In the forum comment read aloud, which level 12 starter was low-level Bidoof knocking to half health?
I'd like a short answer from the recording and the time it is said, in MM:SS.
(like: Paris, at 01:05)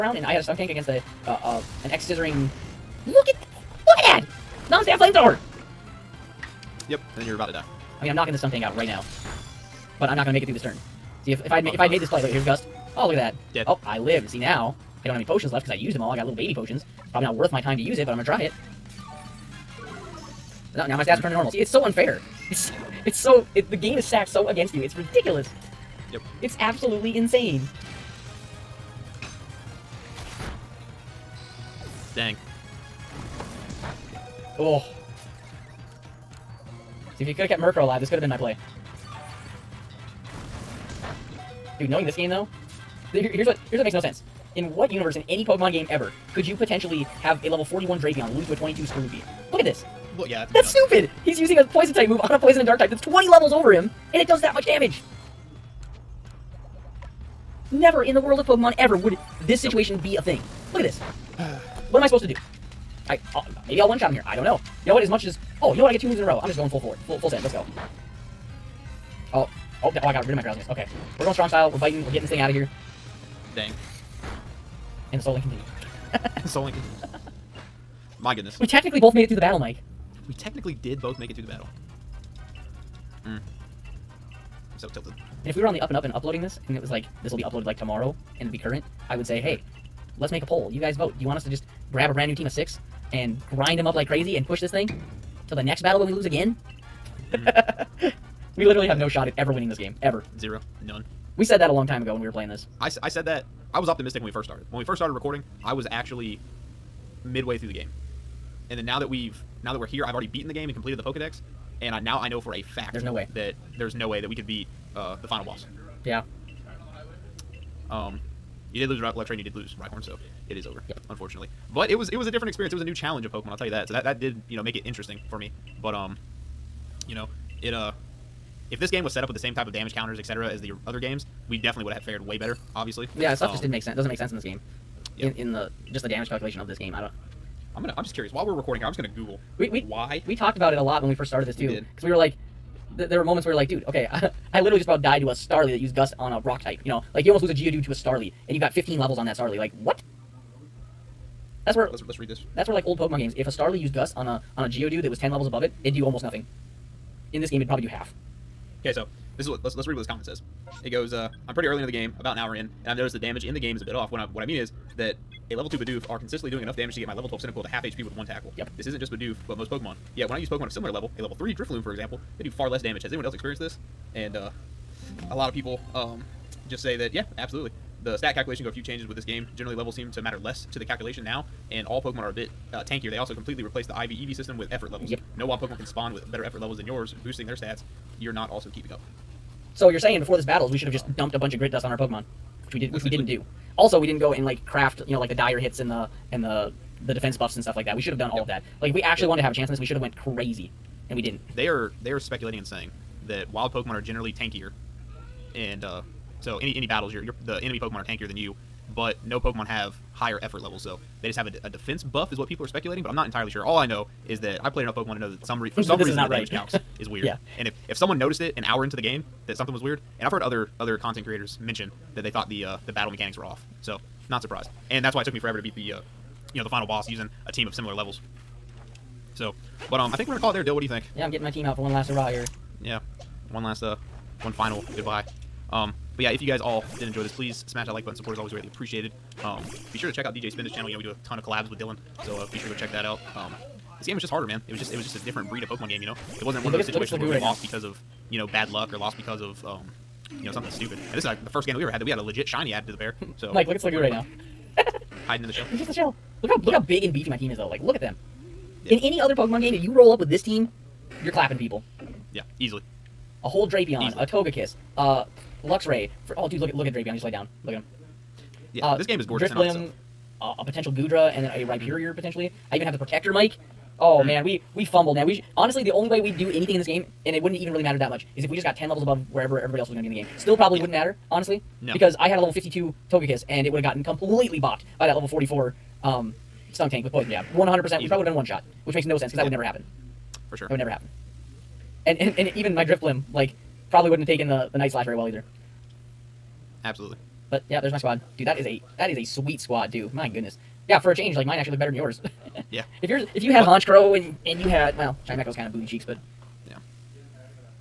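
Cyndaquil, at 02:47.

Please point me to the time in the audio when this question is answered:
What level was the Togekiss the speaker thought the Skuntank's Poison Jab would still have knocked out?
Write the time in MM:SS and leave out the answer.
04:42.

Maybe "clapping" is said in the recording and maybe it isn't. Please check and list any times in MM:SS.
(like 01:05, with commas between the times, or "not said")
04:21.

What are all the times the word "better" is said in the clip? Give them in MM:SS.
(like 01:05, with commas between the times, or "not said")
02:12, 03:06, 05:01.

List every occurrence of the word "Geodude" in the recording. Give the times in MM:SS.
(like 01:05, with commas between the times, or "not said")
02:27, 02:34.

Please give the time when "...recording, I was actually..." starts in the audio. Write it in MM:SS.
01:45.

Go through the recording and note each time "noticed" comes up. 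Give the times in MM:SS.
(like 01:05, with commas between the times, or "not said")
02:42, 03:38.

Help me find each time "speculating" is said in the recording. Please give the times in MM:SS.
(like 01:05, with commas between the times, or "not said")
03:22, 03:32.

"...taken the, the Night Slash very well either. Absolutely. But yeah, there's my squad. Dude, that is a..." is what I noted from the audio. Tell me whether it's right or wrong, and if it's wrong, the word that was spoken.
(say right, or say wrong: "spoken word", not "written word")
right.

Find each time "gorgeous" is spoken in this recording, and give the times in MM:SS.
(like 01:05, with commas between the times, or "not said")
04:29.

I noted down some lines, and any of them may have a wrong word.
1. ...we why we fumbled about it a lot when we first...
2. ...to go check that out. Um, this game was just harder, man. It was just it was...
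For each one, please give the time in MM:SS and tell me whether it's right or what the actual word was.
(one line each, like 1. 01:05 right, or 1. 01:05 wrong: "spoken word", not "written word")
1. 02:19 wrong: "talked", not "fumbled"
2. 04:02 right.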